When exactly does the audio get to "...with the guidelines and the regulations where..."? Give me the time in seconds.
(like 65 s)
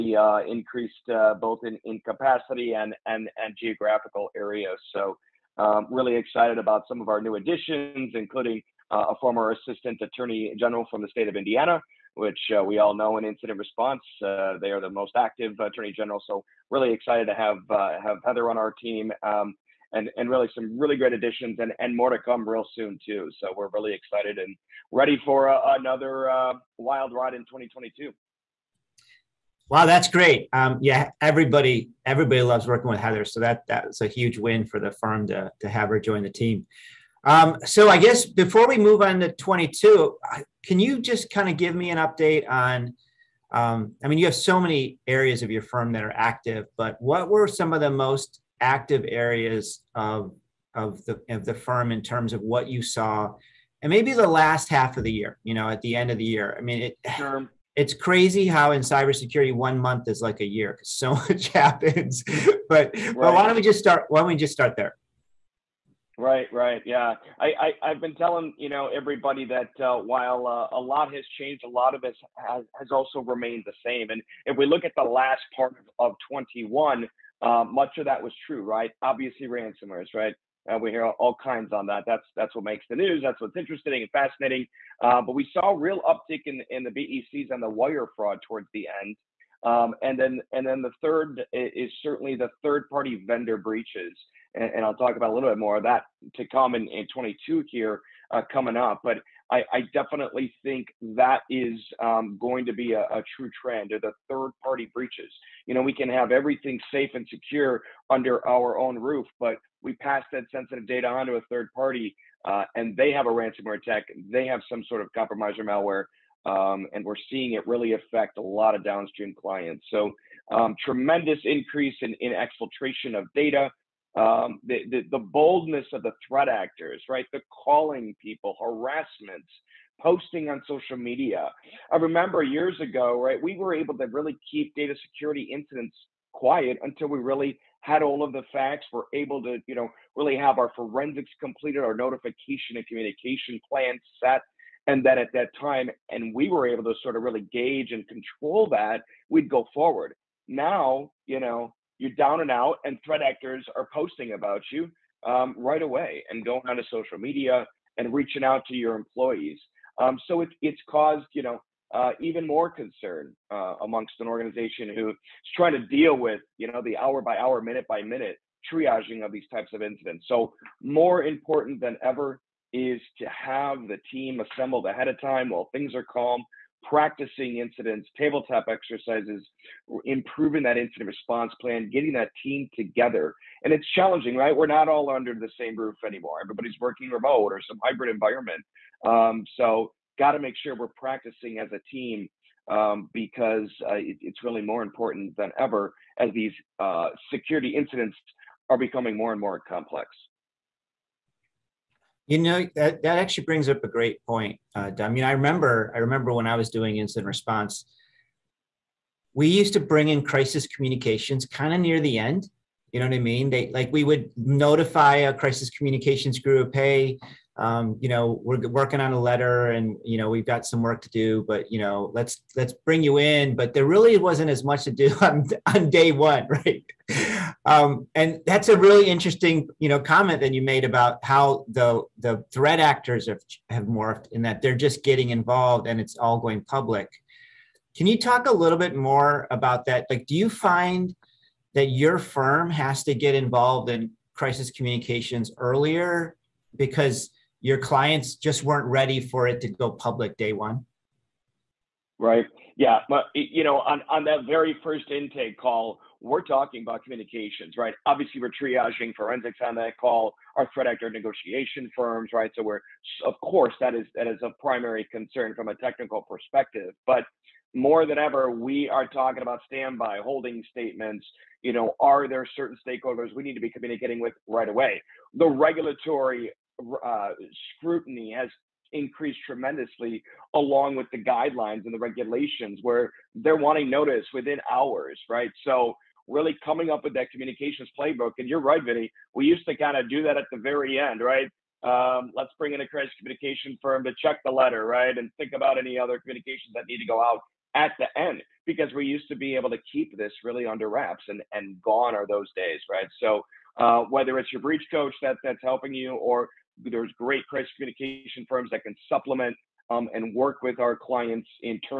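280 s.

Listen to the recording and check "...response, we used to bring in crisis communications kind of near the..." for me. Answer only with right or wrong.
right.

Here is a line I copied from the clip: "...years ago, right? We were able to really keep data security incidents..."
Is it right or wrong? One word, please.
right.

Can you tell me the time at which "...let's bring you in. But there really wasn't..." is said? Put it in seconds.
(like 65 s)
222 s.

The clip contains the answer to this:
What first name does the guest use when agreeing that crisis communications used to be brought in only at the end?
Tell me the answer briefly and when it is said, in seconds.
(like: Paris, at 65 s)
Vinny, at 288 s.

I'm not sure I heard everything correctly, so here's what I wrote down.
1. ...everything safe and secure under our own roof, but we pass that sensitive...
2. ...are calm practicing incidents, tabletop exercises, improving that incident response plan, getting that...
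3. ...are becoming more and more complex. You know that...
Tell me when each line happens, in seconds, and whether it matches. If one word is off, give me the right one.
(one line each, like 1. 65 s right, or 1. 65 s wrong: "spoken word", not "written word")
1. 106 s right
2. 175 s right
3. 198 s right.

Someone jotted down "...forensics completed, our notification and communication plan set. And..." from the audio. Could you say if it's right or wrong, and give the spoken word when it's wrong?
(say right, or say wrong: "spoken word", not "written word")
right.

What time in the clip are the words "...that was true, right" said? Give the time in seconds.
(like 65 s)
78 s.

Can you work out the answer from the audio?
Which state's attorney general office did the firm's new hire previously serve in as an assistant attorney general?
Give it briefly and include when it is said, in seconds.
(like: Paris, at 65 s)
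Indiana, at 11 s.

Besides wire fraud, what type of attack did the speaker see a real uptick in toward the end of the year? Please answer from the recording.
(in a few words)
BECs.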